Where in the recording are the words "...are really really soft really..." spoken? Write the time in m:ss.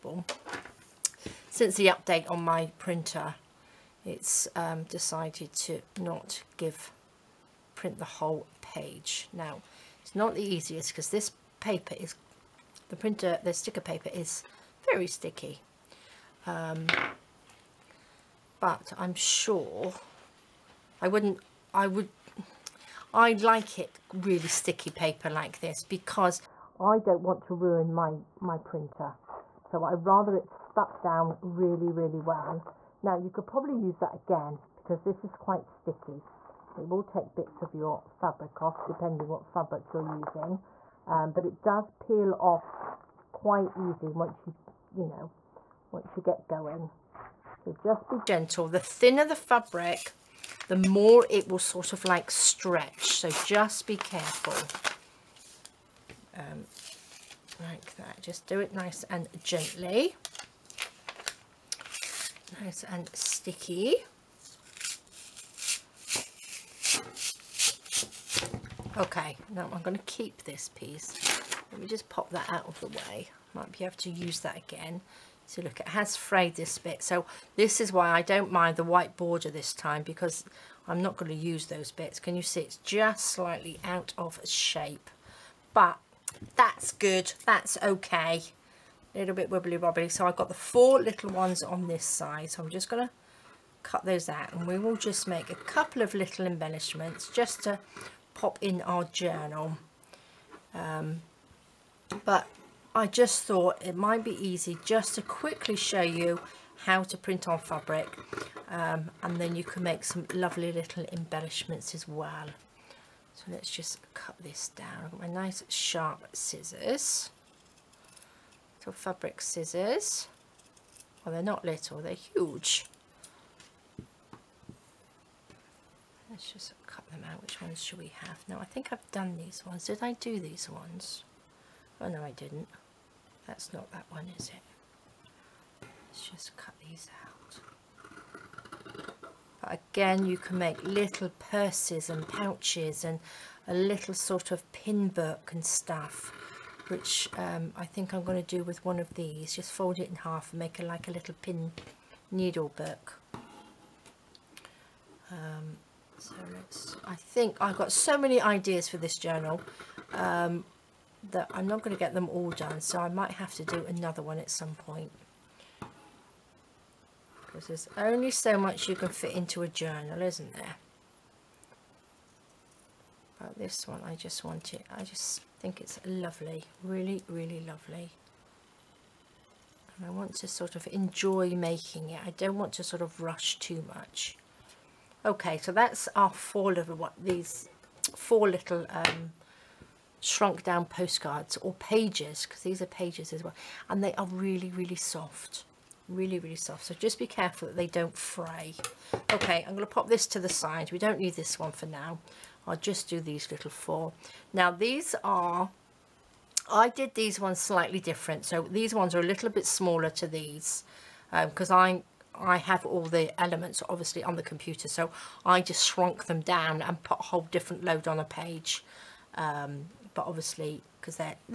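3:14.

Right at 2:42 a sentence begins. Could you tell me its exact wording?
So I might have to do another one at some point.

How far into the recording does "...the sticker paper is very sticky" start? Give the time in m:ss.
0:13.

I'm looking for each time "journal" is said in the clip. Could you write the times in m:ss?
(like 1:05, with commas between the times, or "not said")
1:39, 2:39, 2:49.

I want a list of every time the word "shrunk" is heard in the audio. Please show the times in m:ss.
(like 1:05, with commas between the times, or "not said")
3:10, 3:35.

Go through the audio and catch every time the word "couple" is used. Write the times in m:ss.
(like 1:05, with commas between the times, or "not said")
1:35.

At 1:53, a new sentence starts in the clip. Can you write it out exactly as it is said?
So let's just cut this down.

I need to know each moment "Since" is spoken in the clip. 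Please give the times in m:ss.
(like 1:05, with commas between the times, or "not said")
0:01.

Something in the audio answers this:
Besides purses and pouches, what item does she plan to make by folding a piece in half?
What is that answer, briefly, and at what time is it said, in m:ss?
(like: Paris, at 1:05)
pin needle book, at 2:31.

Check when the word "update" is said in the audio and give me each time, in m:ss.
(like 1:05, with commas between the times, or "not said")
0:01.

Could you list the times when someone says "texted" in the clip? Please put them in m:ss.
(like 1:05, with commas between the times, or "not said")
not said.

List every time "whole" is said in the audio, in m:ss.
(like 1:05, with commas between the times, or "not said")
0:08, 3:37.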